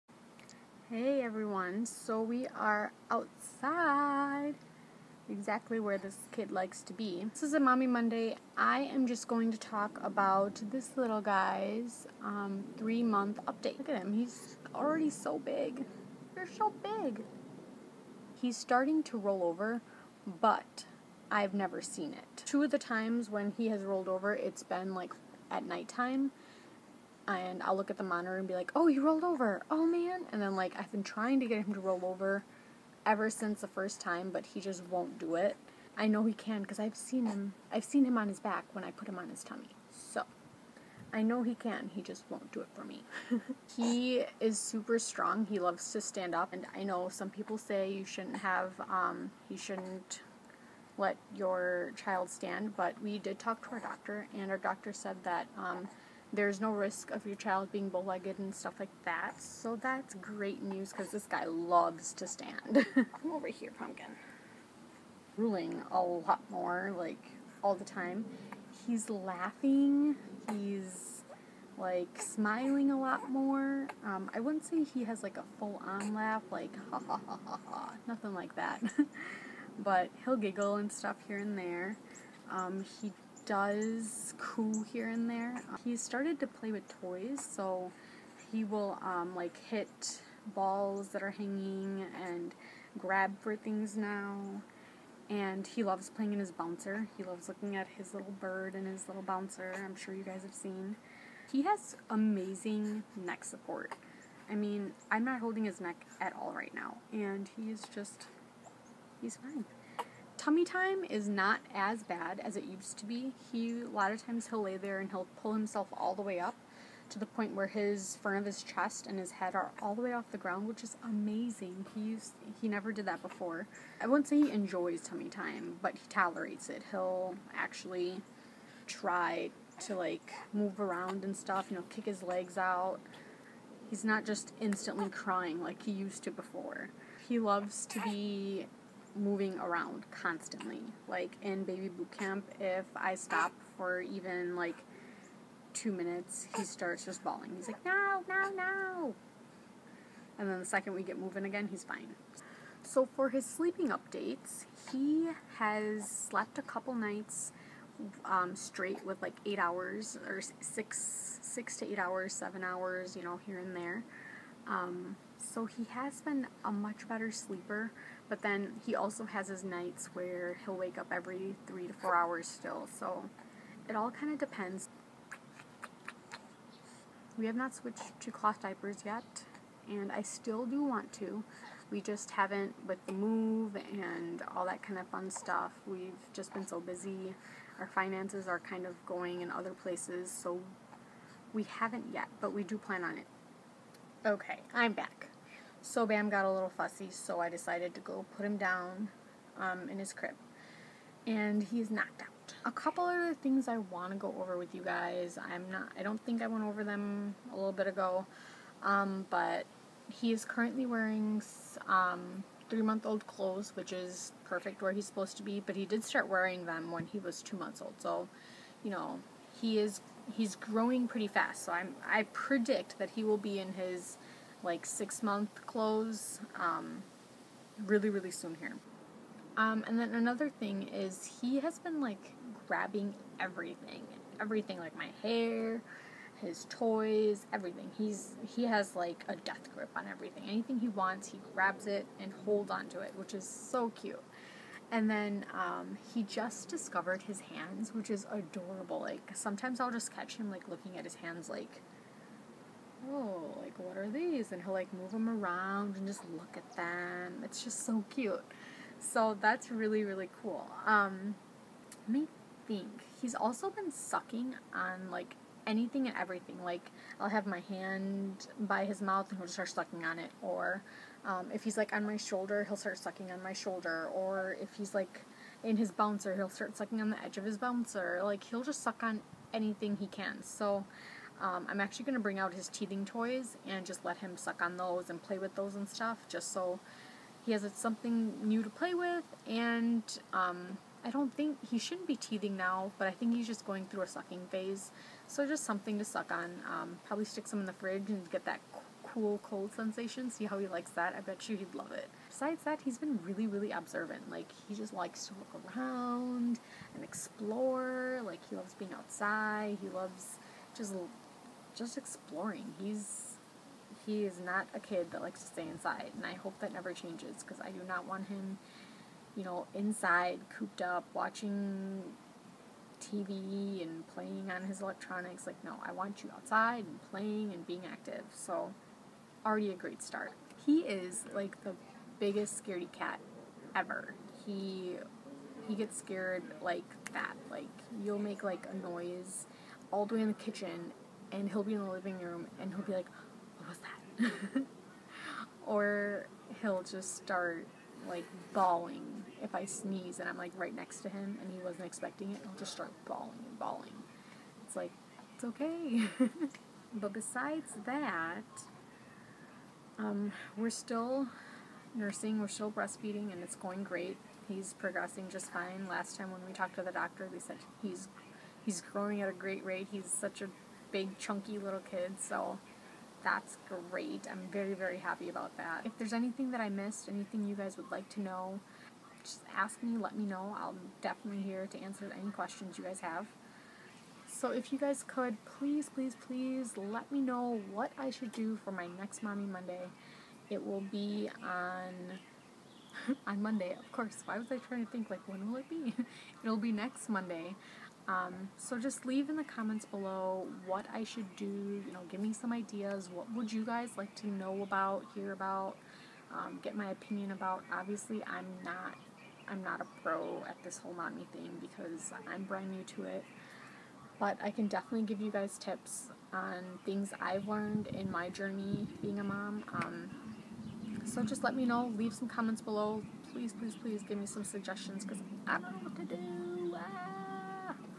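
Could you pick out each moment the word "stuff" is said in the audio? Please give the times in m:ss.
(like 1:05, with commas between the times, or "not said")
0:58, 1:20, 2:11, 3:05, 4:45.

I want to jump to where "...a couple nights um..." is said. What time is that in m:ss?
2:36.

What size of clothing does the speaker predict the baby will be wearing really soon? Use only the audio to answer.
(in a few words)
6 month clothes.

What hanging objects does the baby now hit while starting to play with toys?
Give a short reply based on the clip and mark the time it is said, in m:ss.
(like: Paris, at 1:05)
Balls, at 1:30.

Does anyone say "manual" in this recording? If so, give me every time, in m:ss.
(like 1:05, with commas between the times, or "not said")
not said.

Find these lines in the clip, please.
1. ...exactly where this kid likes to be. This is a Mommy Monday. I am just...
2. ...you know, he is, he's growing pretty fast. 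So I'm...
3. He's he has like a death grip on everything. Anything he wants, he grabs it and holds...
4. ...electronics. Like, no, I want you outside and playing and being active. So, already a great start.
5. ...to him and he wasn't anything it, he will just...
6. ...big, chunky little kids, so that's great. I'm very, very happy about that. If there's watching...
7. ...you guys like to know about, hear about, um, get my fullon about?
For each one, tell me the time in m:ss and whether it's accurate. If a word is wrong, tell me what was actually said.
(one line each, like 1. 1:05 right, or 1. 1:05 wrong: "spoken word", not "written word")
1. 0:05 right
2. 3:38 right
3. 3:57 right
4. 5:24 right
5. 5:51 wrong: "expecting", not "anything"
6. 6:10 wrong: "anything", not "watching"
7. 6:43 wrong: "opinion", not "fullon".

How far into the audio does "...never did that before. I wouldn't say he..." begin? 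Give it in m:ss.
2:02.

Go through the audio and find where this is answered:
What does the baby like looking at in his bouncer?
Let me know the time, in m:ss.
1:37.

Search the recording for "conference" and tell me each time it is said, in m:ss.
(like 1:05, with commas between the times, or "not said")
not said.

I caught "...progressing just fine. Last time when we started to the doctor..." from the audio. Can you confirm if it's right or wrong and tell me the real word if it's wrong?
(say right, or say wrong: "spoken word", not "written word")
wrong: "talked", not "started".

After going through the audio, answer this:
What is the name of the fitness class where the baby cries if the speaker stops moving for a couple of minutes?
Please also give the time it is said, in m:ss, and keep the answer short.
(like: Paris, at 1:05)
Baby boot camp, at 2:21.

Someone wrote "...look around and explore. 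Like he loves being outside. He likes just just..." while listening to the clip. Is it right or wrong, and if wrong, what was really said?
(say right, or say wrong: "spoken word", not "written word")
wrong: "loves", not "likes".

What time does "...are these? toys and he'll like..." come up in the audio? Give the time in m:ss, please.
4:13.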